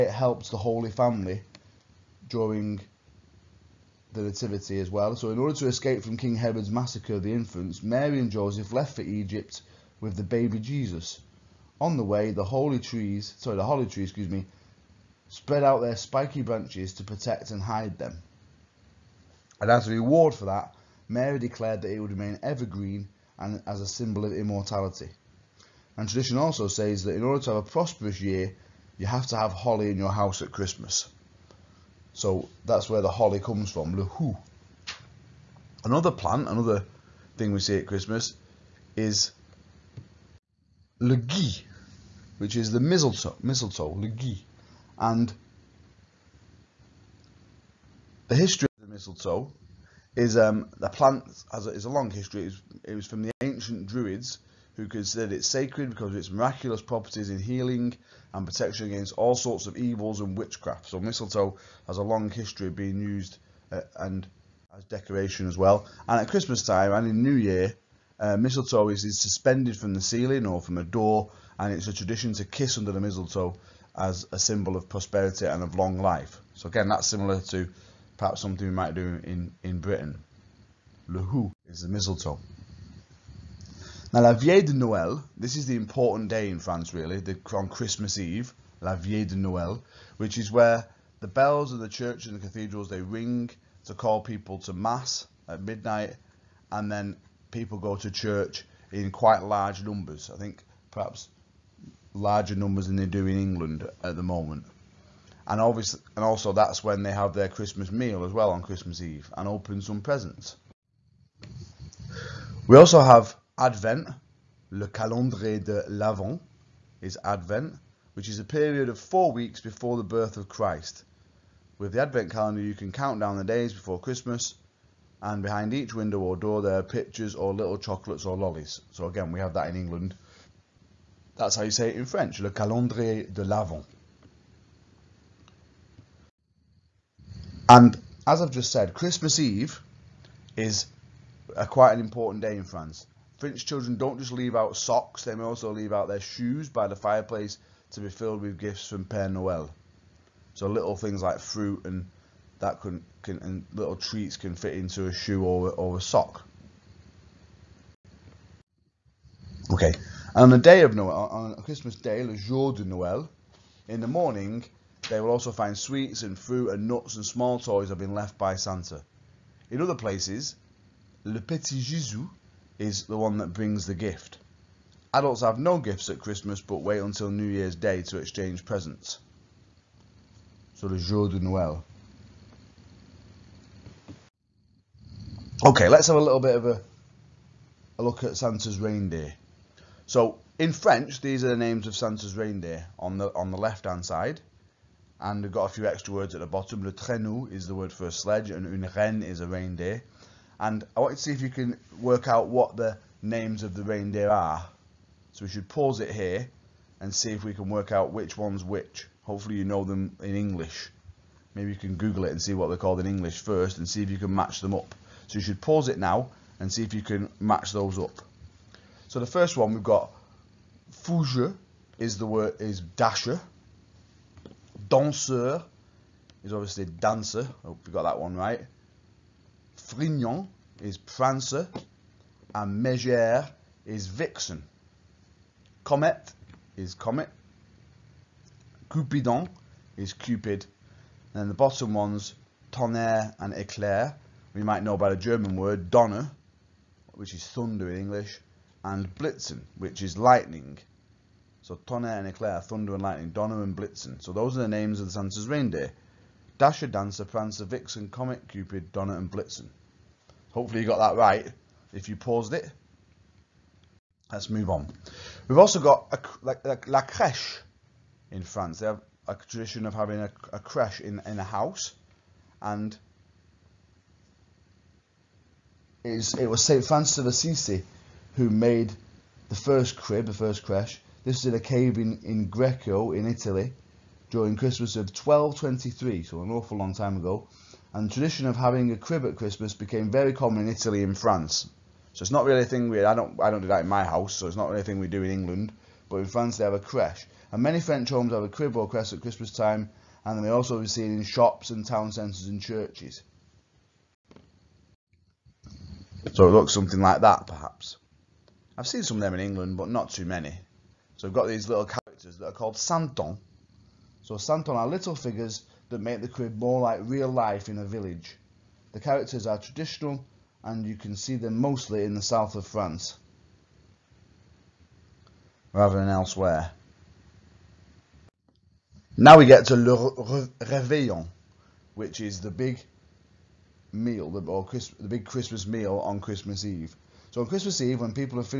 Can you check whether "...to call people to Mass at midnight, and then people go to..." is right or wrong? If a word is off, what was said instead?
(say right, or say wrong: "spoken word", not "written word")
right.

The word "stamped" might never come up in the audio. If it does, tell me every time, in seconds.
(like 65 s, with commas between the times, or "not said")
not said.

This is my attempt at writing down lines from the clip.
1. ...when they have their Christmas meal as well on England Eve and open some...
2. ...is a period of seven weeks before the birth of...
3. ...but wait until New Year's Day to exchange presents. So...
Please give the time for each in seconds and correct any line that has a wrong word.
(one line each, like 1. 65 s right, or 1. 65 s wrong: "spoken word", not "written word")
1. 106 s wrong: "Christmas", not "England"
2. 118 s wrong: "four", not "seven"
3. 176 s right.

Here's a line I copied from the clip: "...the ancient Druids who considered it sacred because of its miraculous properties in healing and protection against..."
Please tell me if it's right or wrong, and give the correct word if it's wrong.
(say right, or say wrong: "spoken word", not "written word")
right.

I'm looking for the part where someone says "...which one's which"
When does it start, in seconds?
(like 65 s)
208 s.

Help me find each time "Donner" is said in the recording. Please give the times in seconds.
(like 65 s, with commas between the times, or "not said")
245 s, 253 s, 258 s.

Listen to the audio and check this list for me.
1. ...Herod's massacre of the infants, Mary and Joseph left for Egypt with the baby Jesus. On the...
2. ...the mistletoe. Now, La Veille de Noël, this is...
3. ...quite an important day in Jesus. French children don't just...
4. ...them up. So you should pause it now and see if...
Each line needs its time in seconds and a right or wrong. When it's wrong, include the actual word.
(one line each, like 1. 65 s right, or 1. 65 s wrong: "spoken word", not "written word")
1. 6 s right
2. 81 s right
3. 141 s wrong: "France", not "Jesus"
4. 214 s right.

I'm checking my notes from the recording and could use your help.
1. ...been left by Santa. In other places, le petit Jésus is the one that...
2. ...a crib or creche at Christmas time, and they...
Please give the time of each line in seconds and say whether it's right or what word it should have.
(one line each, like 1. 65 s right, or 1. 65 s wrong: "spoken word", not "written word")
1. 167 s right
2. 298 s right.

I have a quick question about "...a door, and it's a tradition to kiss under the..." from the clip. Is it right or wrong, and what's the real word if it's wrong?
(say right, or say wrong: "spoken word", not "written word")
right.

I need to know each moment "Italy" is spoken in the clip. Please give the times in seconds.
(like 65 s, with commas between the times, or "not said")
283 s, 290 s.